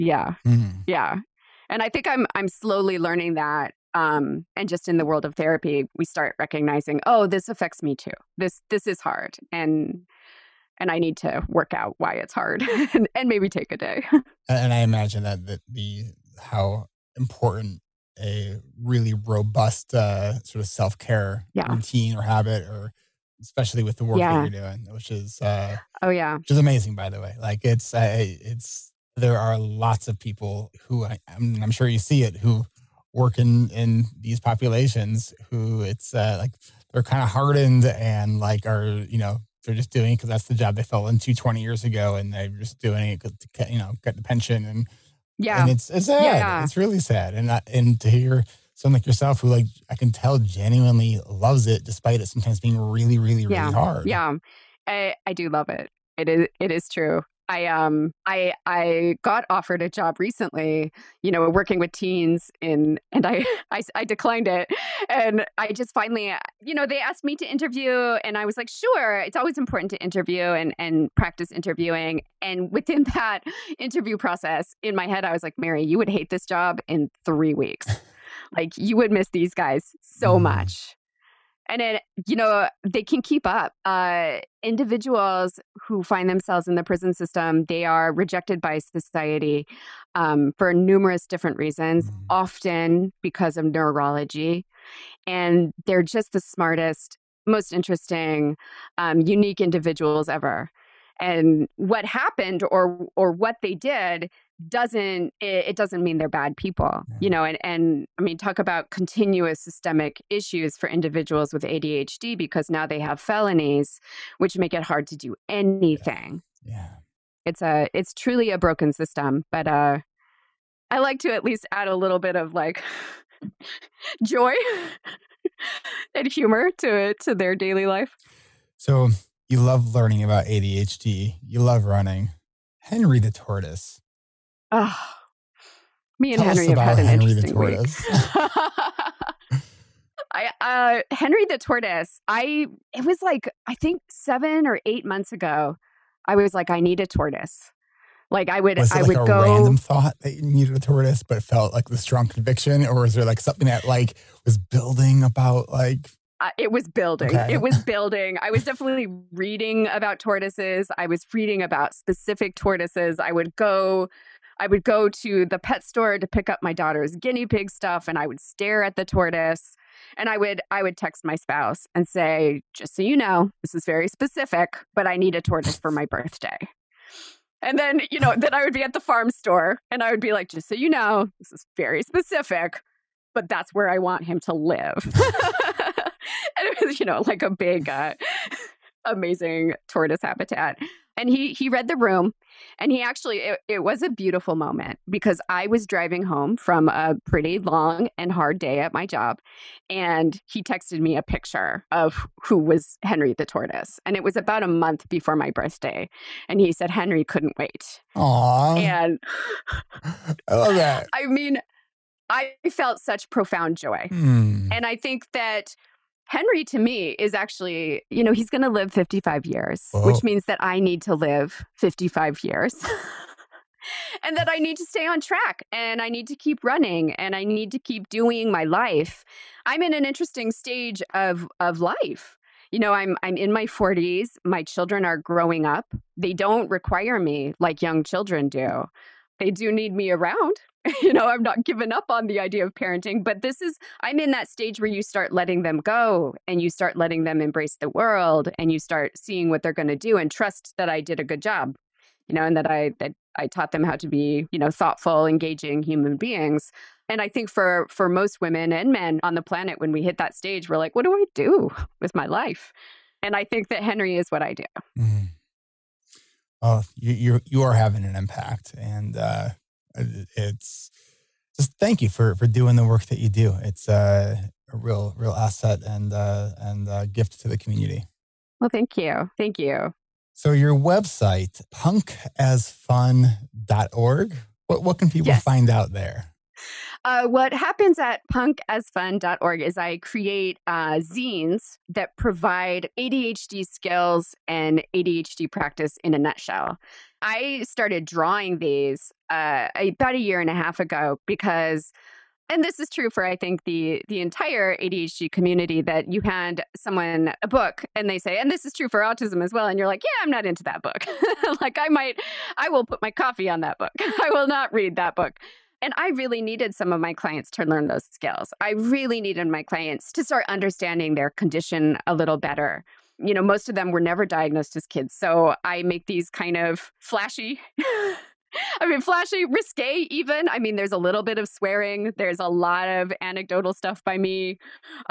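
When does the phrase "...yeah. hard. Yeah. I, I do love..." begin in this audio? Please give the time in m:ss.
0:53.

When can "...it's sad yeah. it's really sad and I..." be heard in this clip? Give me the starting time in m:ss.
0:45.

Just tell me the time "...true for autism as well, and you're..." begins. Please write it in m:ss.
5:08.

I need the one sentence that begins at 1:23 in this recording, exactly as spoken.
Uh, individuals who find themselves in the prison system, they are rejected by society um, for numerous different reasons, mm.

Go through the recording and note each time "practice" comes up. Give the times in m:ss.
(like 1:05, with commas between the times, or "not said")
1:11, 4:55.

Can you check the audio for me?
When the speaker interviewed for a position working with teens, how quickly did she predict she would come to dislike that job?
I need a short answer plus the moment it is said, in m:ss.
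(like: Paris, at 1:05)
3 weeks, at 1:17.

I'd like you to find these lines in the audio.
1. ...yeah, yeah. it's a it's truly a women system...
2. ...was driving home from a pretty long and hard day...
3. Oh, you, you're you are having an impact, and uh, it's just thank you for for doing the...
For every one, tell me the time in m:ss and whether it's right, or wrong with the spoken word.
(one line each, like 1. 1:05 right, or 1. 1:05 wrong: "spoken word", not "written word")
1. 1:56 wrong: "broken", not "women"
2. 3:15 right
3. 4:26 right.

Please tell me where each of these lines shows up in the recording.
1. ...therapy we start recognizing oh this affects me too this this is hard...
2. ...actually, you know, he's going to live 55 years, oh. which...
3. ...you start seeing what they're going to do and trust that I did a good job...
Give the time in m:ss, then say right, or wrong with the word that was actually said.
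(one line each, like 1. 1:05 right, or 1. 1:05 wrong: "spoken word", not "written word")
1. 0:05 right
2. 3:37 right
3. 4:08 right.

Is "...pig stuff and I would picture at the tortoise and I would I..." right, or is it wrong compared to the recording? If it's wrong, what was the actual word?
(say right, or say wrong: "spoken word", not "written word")
wrong: "stare", not "picture".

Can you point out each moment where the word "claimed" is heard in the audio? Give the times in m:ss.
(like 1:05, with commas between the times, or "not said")
not said.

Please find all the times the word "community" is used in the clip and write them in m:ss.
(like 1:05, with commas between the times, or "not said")
4:37, 5:05.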